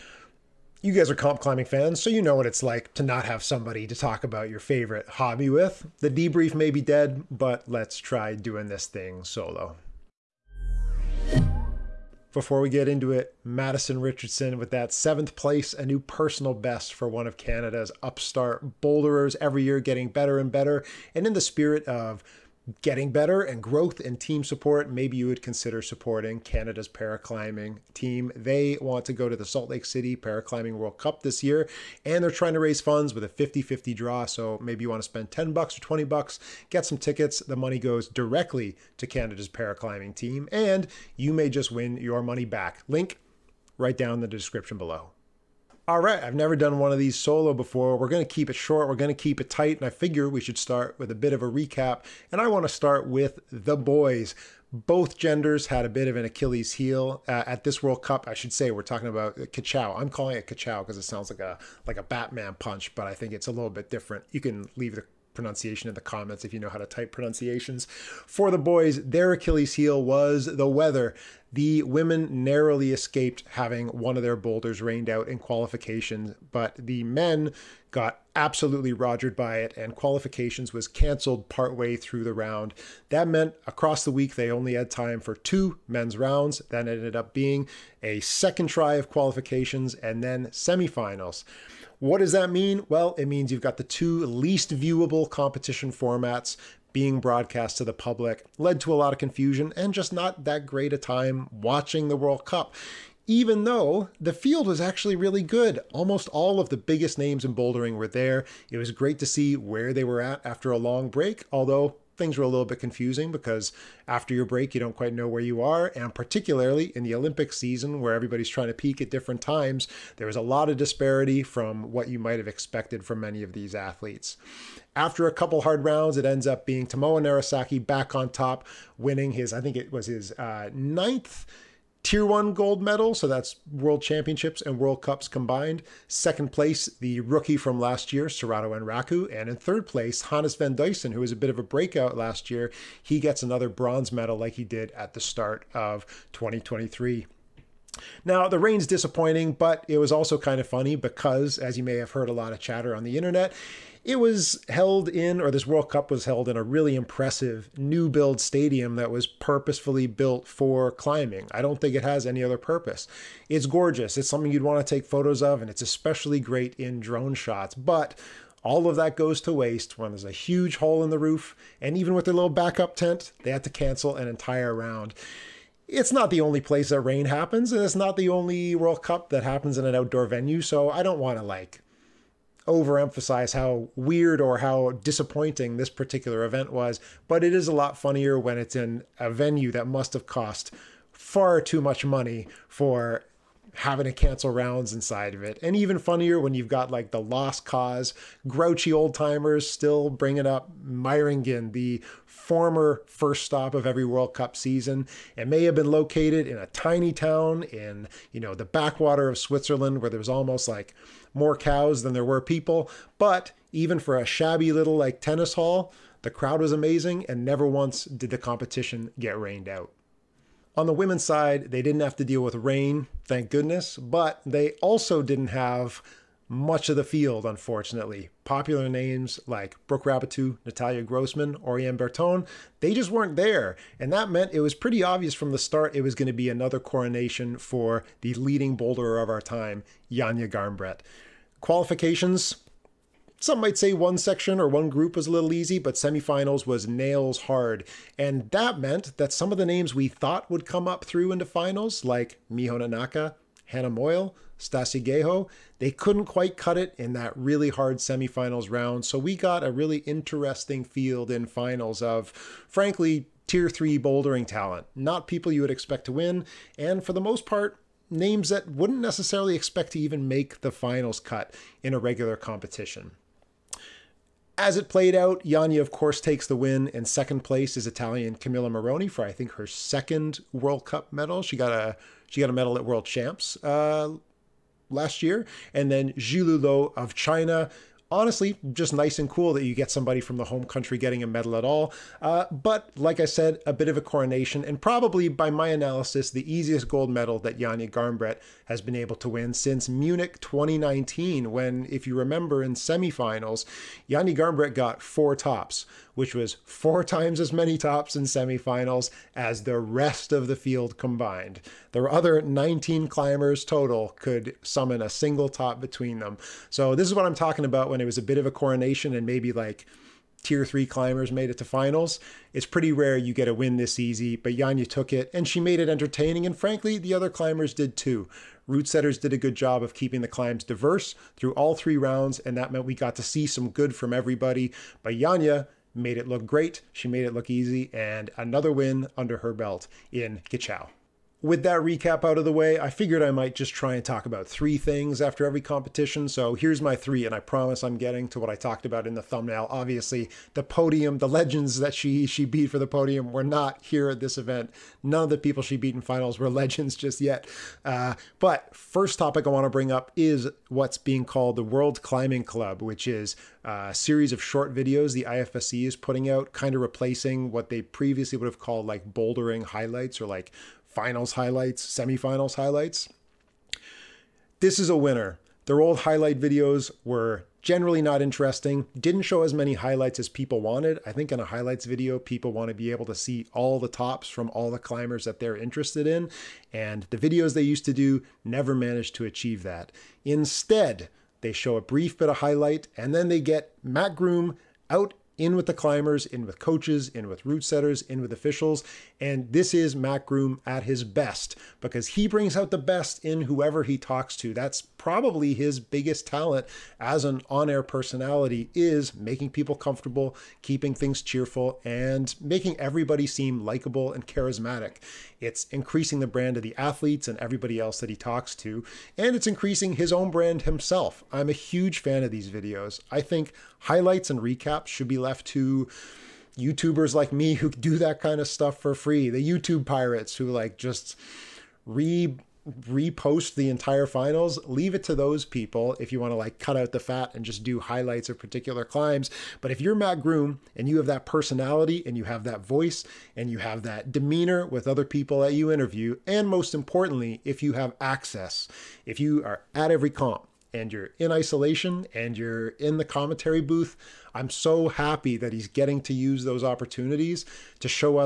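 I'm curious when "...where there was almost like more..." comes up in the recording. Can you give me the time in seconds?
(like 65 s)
209 s.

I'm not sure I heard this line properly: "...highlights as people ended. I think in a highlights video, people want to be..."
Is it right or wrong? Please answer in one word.
wrong.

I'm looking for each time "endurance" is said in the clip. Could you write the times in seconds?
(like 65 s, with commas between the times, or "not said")
not said.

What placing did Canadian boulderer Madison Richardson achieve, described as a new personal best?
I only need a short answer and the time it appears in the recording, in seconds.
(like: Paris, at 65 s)
7th, at 14 s.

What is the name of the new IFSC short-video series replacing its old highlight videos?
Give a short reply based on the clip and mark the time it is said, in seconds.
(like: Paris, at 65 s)
World Climbing Club, at 361 s.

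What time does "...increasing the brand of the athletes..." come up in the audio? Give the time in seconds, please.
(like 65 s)
415 s.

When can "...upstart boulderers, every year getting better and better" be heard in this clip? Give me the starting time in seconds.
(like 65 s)
18 s.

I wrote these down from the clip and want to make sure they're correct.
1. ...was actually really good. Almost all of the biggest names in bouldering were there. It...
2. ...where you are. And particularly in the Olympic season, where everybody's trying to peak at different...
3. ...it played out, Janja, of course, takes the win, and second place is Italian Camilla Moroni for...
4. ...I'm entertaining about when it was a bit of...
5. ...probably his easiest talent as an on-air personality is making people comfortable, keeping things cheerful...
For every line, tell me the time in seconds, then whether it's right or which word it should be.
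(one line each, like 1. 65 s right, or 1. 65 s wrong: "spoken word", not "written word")
1. 104 s right
2. 115 s right
3. 274 s right
4. 317 s wrong: "talking", not "entertaining"
5. 404 s wrong: "biggest", not "easiest".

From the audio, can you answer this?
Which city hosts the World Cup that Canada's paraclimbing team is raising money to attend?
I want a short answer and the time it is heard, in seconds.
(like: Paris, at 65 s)
Salt Lake City, at 29 s.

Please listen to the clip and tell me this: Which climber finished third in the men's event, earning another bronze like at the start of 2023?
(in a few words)
Hannes van Duysen.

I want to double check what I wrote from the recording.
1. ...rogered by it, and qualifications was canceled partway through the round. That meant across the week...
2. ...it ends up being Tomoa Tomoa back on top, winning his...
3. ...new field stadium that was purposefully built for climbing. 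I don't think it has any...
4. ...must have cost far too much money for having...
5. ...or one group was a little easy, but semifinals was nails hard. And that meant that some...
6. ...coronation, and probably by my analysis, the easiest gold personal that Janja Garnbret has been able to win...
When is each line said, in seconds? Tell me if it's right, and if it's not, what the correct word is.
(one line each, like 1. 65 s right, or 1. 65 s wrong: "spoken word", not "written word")
1. 78 s right
2. 126 s wrong: "Narasaki", not "Tomoa"
3. 157 s wrong: "build", not "field"
4. 189 s right
5. 244 s right
6. 293 s wrong: "medal", not "personal".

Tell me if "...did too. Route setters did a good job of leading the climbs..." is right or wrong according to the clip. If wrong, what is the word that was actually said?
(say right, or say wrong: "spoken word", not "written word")
wrong: "keeping", not "leading".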